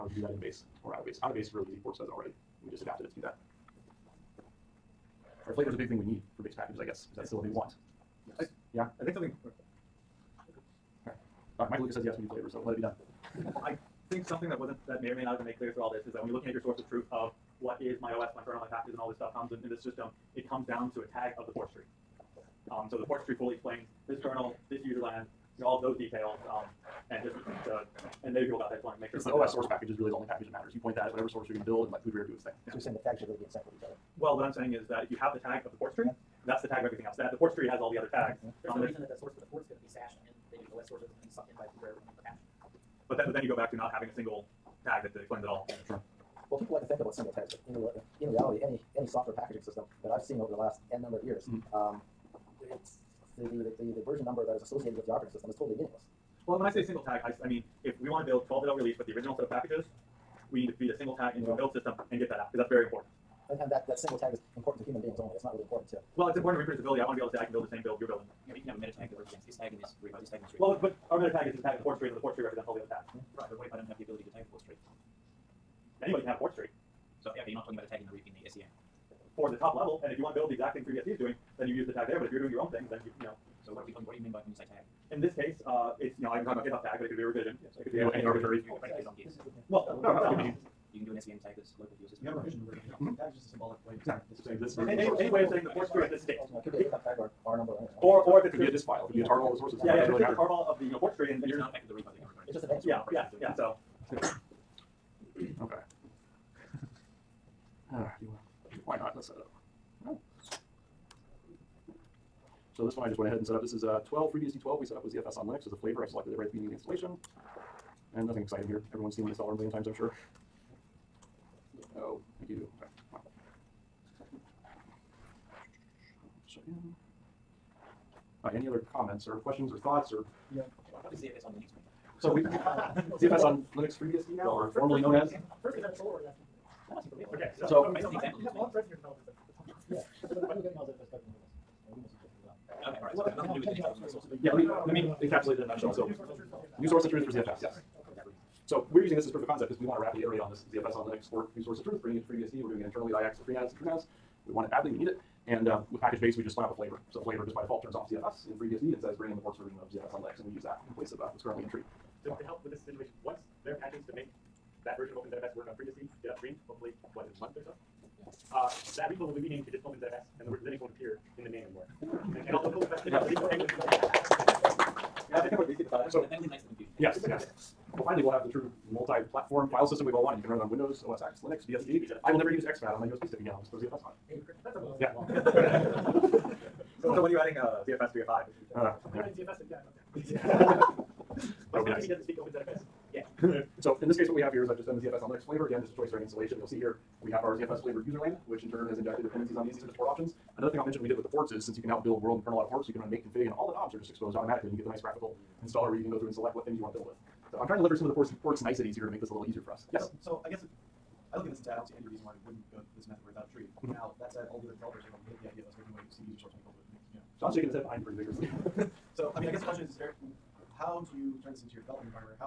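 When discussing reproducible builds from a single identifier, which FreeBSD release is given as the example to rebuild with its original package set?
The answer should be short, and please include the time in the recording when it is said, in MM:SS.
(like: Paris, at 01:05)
12.0, at 00:58.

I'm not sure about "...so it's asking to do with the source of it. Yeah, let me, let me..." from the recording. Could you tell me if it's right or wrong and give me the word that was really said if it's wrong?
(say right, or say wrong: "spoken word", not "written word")
wrong: "nothing", not "asking".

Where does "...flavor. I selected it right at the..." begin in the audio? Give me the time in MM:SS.
01:55.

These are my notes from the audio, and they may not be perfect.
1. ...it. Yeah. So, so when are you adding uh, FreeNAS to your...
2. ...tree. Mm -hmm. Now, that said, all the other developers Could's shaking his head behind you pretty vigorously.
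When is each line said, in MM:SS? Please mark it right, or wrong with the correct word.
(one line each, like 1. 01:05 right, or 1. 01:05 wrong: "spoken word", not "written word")
1. 03:04 wrong: "ZFS", not "FreeNAS"
2. 03:33 wrong: "John", not "Could".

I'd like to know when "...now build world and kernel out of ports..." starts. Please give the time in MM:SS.
03:21.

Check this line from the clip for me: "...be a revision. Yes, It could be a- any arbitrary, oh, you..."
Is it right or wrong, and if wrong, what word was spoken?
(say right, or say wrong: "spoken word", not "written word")
right.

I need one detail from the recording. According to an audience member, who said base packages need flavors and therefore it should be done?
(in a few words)
Michael Lucas.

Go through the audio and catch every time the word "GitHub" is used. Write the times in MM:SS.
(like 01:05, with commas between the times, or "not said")
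01:26, 01:36.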